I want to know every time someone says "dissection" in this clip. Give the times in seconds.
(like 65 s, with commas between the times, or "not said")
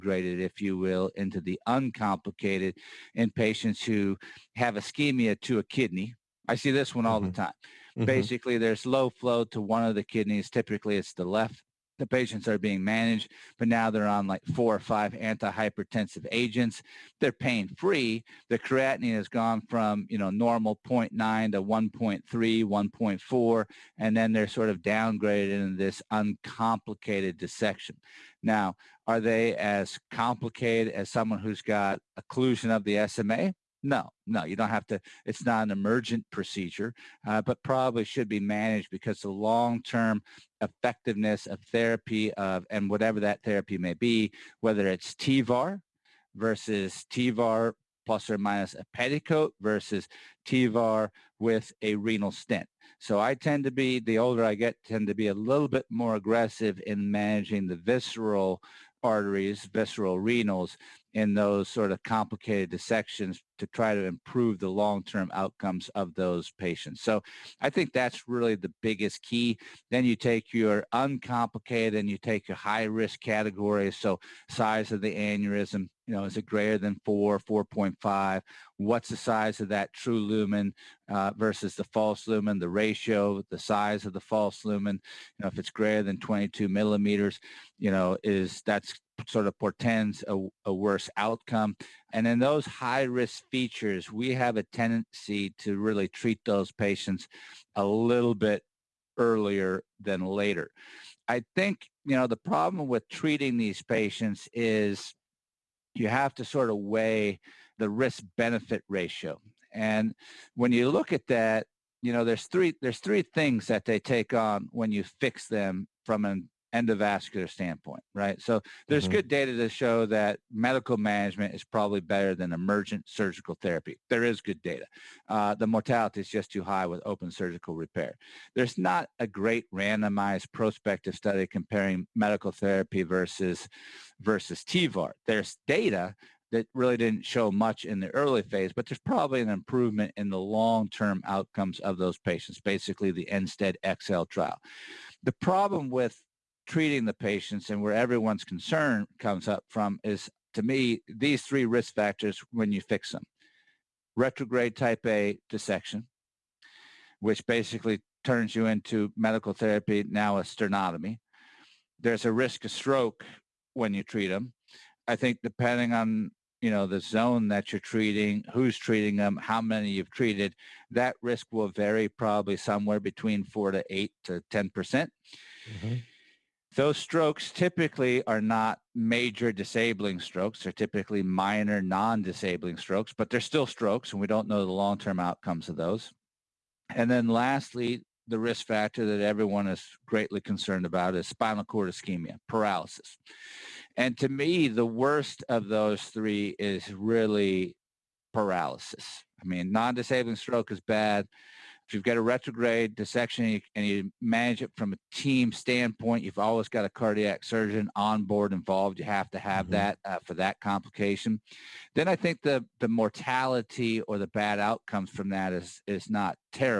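27 s, 62 s, 155 s, 202 s.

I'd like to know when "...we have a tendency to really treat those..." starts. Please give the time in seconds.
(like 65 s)
94 s.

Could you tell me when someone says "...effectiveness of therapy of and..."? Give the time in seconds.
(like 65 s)
40 s.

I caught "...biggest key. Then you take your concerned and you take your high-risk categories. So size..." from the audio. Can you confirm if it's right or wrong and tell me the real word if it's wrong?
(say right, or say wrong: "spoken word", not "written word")
wrong: "uncomplicated", not "concerned".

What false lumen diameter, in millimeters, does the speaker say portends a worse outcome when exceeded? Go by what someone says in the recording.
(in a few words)
22 millimeters.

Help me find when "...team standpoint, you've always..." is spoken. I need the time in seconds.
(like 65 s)
205 s.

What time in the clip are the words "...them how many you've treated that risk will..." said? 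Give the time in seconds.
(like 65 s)
169 s.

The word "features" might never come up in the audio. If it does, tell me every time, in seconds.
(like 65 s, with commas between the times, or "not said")
93 s.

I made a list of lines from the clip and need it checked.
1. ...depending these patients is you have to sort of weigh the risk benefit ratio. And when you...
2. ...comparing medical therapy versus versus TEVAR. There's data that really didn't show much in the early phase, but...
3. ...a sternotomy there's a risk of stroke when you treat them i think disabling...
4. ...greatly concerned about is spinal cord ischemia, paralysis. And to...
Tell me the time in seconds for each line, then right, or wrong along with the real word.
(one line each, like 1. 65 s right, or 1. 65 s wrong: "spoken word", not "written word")
1. 103 s wrong: "treating", not "depending"
2. 131 s right
3. 160 s wrong: "depending", not "disabling"
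4. 190 s right.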